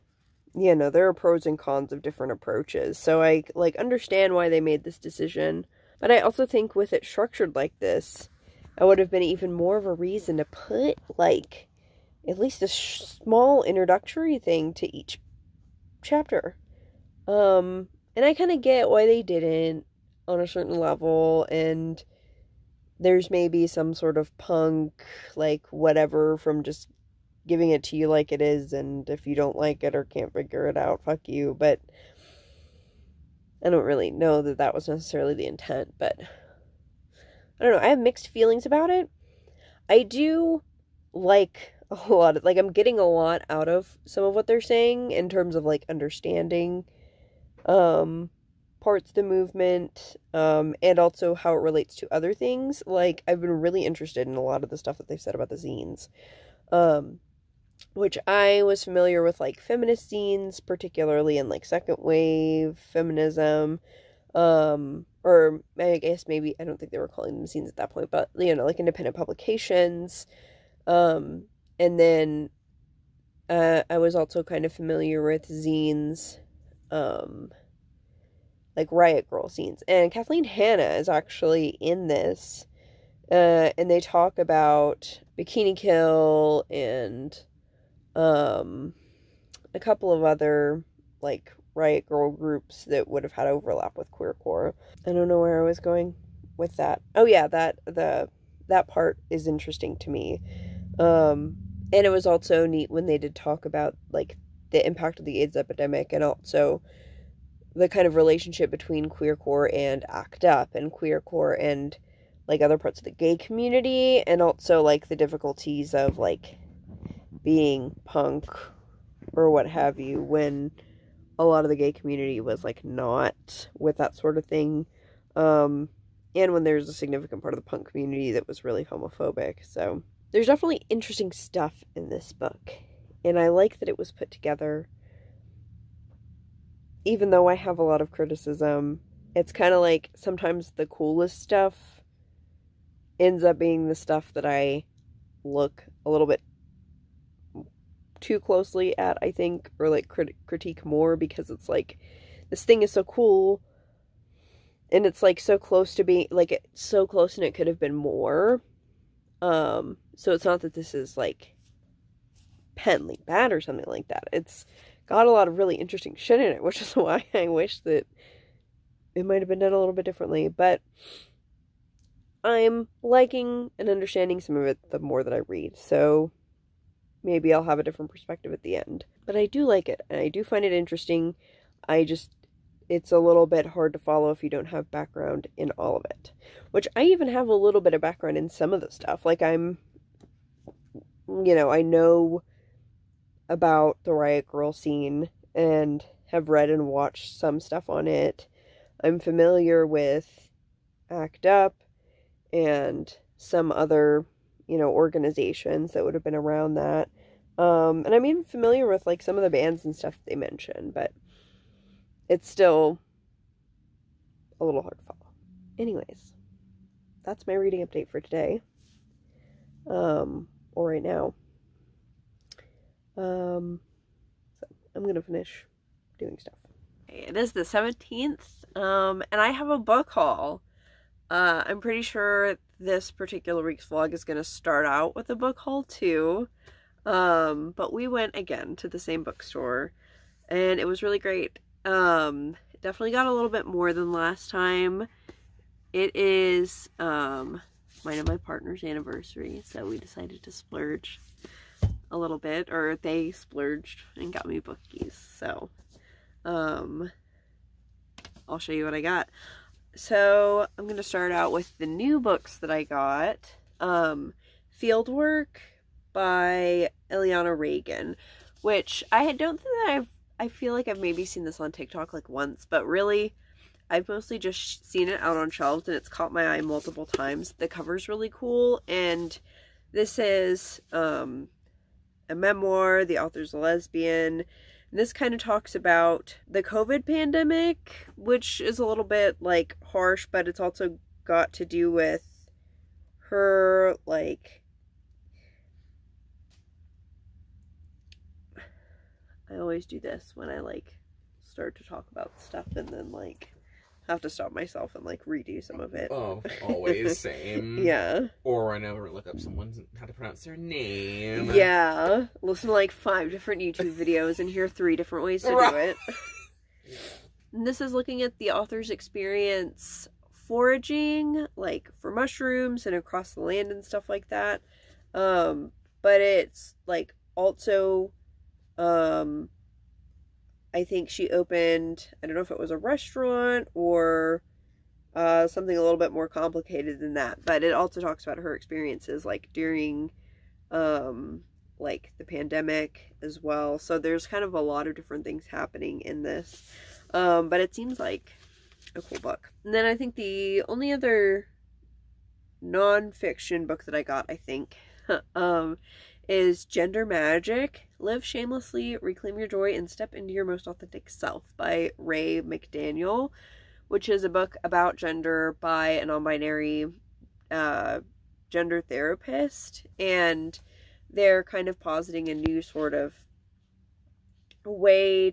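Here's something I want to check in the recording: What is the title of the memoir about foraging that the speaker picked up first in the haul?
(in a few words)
Fieldwork.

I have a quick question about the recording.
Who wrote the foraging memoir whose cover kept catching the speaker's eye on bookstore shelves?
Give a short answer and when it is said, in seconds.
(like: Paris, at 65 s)
Iliana Regan, at 267 s.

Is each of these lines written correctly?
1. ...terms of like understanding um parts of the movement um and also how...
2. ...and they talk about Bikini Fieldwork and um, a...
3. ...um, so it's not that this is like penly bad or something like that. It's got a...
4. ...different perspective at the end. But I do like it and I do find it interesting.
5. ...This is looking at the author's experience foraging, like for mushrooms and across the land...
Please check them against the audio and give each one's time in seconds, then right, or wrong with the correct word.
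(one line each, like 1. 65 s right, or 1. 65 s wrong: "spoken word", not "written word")
1. 45 s right
2. 83 s wrong: "Kill", not "Fieldwork"
3. 159 s right
4. 177 s right
5. 317 s right.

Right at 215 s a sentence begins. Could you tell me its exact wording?
Anyways, that's my reading update for today.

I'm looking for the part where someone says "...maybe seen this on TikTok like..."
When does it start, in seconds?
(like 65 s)
270 s.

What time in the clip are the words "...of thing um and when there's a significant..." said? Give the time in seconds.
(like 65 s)
124 s.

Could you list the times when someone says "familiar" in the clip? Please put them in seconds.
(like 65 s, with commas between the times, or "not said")
58 s, 74 s, 199 s, 208 s.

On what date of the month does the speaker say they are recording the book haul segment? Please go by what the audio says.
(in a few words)
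17th.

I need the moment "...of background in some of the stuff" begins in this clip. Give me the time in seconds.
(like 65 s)
187 s.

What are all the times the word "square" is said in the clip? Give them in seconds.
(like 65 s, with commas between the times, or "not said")
not said.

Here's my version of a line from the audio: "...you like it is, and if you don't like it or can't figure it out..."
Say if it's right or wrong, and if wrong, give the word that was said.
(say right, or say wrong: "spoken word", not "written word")
right.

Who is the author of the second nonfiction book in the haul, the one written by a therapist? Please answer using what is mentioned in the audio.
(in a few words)
Ray McDaniel.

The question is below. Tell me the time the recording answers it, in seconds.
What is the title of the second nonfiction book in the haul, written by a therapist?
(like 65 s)
356 s.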